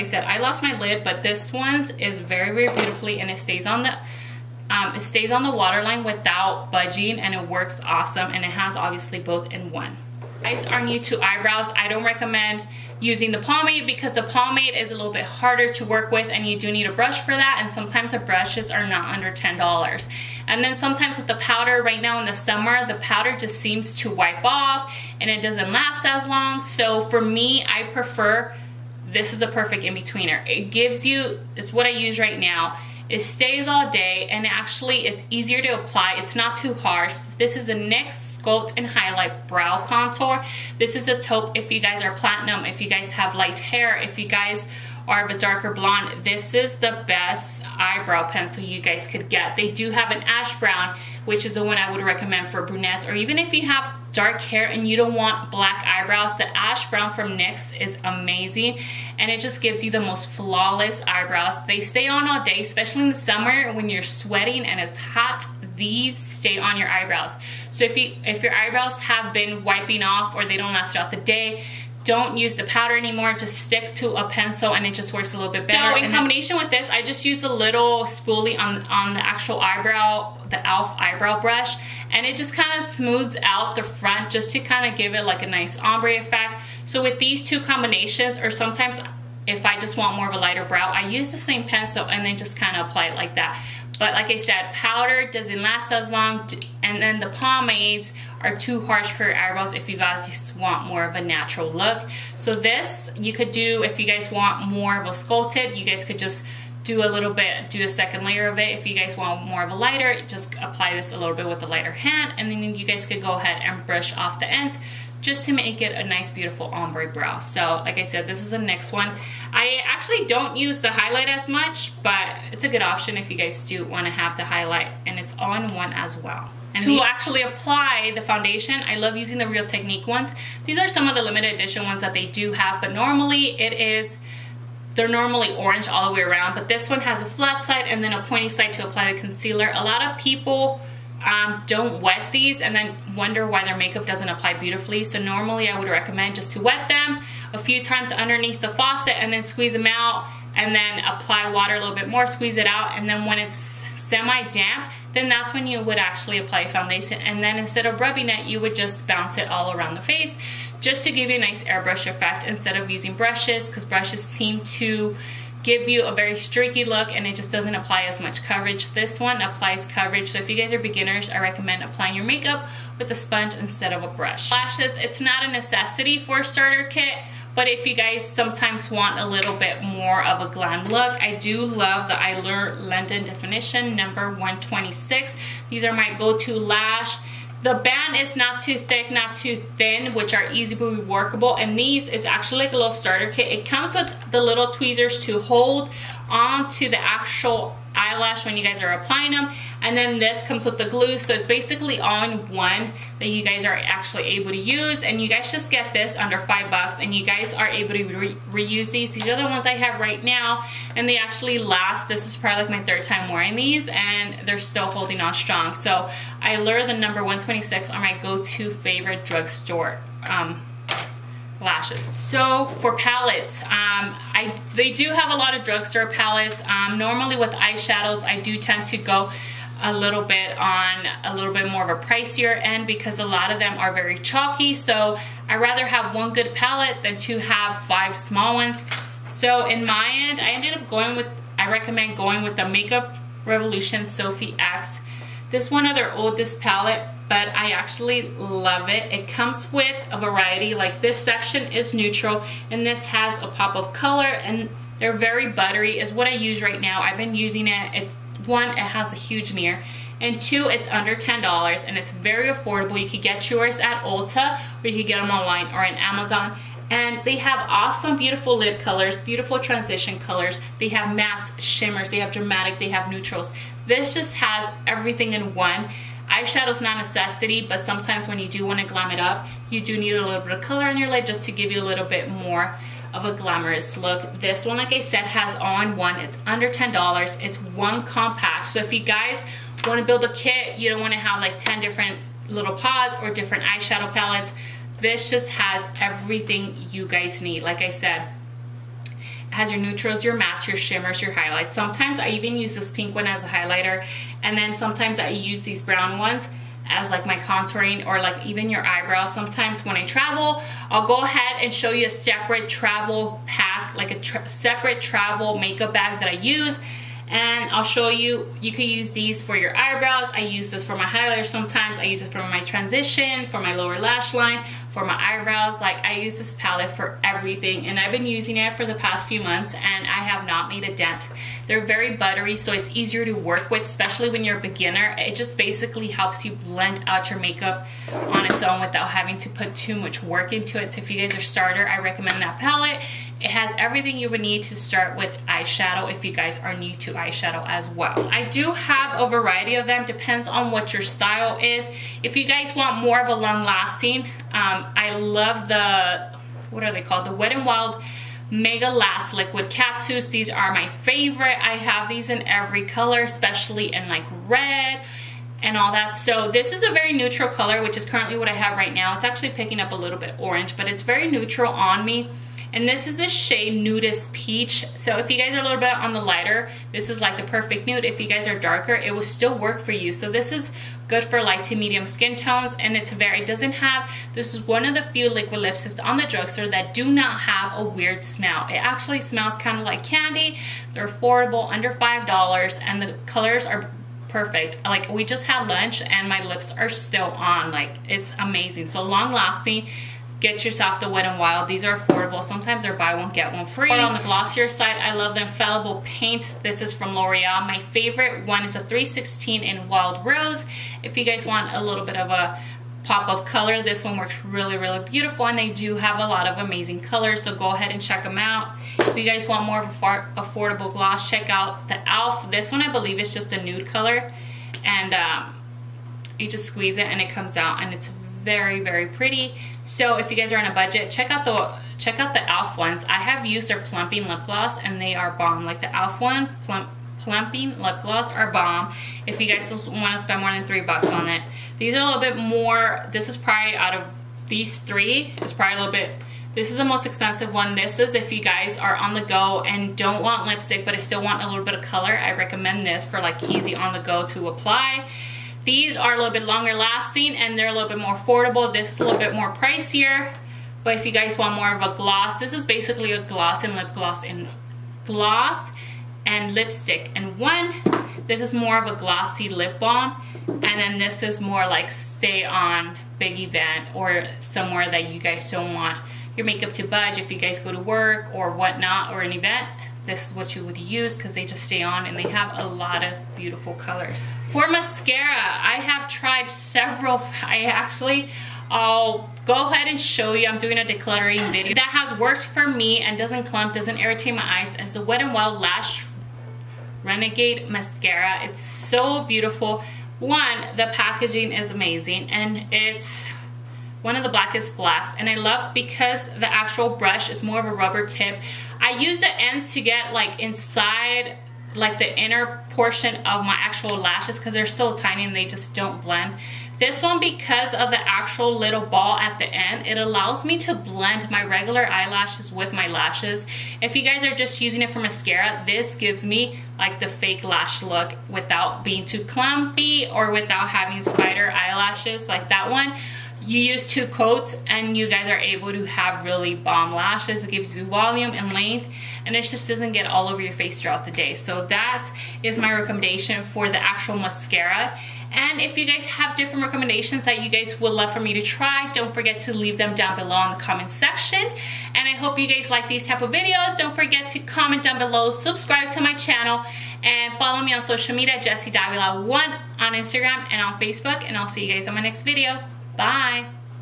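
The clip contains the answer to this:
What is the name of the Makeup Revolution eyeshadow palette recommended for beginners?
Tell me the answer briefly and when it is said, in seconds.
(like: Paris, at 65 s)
Sophie X, at 244 s.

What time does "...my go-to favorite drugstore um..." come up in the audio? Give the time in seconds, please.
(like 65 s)
217 s.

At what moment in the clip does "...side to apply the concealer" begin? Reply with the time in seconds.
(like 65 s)
138 s.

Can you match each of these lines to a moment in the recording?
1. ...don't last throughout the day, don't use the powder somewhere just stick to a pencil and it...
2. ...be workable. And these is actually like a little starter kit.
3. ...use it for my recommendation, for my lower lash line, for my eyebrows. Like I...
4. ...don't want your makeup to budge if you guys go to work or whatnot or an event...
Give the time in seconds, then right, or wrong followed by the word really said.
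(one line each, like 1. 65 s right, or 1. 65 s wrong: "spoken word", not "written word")
1. 70 s wrong: "anymore", not "somewhere"
2. 190 s right
3. 322 s wrong: "transition", not "recommendation"
4. 475 s right.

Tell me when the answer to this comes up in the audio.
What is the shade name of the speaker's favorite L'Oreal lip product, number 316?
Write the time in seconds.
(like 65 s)
409 s.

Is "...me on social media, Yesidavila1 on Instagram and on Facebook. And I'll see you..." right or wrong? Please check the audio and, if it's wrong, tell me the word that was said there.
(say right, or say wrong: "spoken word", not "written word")
right.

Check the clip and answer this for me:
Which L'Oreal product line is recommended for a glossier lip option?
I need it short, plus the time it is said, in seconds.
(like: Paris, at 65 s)
Infallible Paint, at 405 s.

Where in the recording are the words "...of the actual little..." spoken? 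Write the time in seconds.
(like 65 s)
517 s.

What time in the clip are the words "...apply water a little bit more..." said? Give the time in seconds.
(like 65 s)
151 s.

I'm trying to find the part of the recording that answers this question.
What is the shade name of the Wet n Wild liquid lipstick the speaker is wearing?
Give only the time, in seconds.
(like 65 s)
373 s.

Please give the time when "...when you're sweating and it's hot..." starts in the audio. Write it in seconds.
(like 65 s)
63 s.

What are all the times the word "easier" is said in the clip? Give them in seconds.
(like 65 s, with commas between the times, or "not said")
35 s, 332 s.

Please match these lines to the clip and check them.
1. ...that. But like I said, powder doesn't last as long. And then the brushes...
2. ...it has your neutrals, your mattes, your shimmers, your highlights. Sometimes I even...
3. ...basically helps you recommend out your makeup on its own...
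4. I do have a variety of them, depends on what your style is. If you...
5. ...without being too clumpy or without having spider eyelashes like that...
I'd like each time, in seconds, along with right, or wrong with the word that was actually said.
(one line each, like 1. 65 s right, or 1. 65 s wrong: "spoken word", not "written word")
1. 93 s wrong: "pomades", not "brushes"
2. 299 s right
3. 335 s wrong: "blend", not "recommend"
4. 348 s right
5. 528 s right.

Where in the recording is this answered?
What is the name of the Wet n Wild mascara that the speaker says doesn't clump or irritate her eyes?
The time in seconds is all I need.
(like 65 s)
495 s.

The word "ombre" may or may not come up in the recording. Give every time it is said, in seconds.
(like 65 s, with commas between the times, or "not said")
85 s, 116 s.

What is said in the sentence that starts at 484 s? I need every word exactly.
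For mascara, I have tried several, I actually, I'll go ahead and show you.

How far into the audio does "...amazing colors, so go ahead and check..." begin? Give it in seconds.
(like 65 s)
416 s.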